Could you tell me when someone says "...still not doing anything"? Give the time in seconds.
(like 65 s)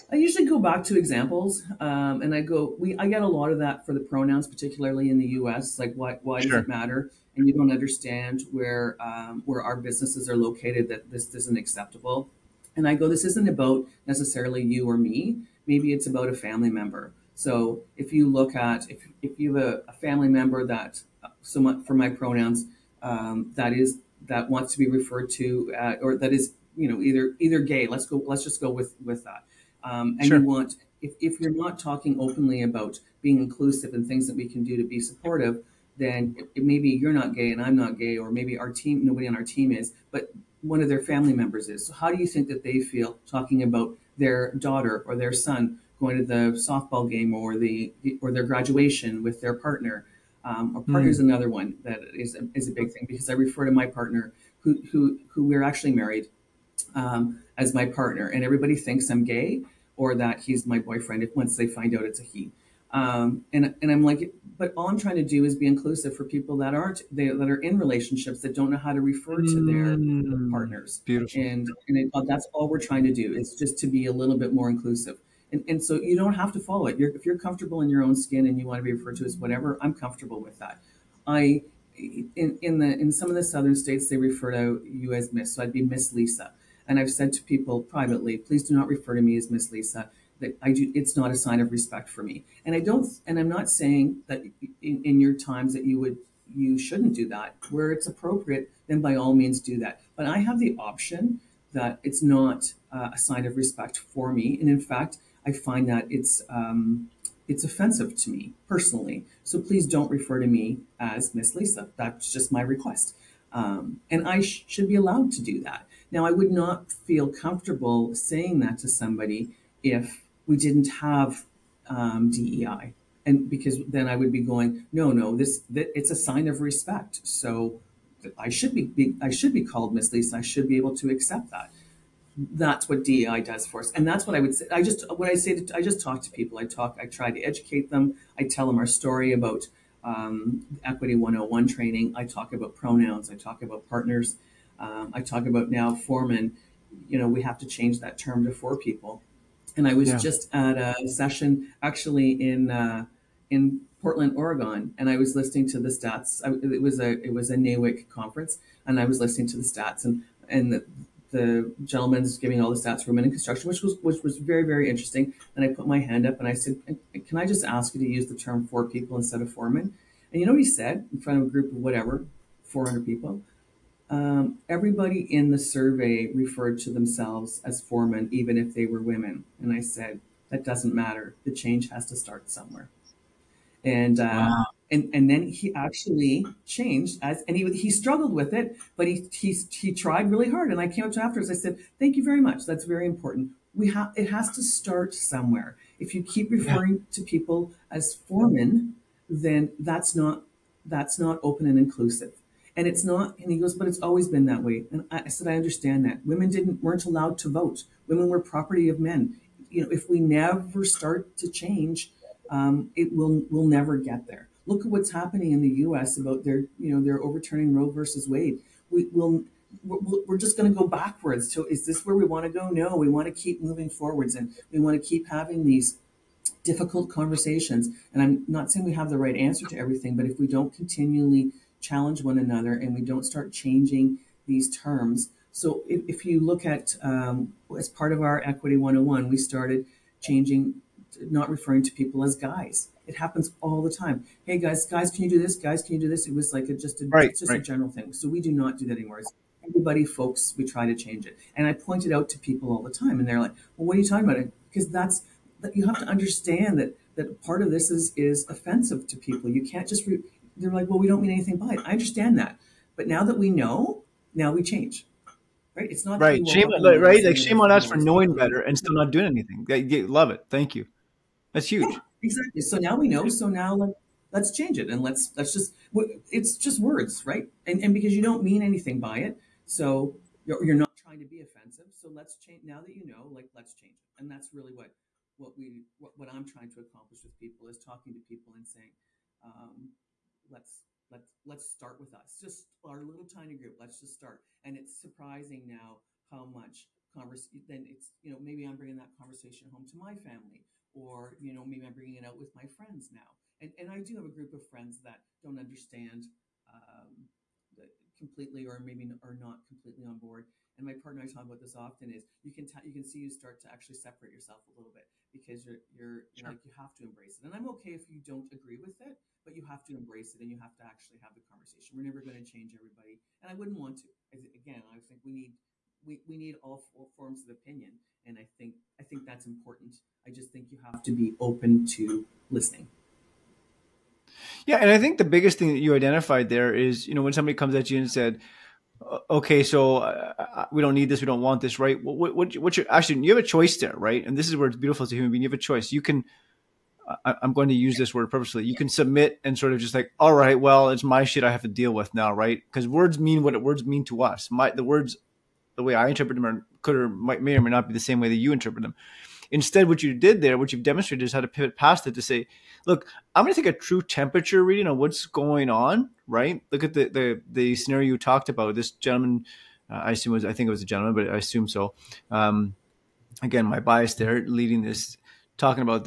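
268 s.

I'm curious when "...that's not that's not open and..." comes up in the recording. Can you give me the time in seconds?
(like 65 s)
199 s.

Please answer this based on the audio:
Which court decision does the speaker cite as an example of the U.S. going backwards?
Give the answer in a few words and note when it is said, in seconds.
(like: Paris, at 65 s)
Roe versus Wade, at 217 s.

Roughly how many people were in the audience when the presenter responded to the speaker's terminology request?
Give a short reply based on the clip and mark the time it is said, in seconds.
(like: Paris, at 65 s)
400, at 172 s.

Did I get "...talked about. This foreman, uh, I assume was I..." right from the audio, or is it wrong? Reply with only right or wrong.
wrong.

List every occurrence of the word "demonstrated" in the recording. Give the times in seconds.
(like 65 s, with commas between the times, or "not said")
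360 s.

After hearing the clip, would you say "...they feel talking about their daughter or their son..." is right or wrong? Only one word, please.
right.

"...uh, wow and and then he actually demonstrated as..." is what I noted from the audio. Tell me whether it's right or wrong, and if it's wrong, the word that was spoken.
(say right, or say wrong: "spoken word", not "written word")
wrong: "changed", not "demonstrated".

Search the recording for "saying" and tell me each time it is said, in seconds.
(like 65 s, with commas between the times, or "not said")
93 s, 118 s, 228 s, 288 s.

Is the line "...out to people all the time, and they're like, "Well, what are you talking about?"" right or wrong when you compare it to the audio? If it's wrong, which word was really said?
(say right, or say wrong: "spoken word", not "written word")
right.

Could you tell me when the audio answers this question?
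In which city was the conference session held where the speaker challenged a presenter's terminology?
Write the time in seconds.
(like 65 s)
154 s.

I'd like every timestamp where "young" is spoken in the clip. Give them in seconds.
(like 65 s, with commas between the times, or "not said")
not said.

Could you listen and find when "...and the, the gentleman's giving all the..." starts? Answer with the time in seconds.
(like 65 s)
160 s.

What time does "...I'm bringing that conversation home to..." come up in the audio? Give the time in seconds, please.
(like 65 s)
298 s.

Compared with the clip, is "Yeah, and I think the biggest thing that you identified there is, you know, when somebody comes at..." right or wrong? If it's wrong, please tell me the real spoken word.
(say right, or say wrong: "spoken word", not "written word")
right.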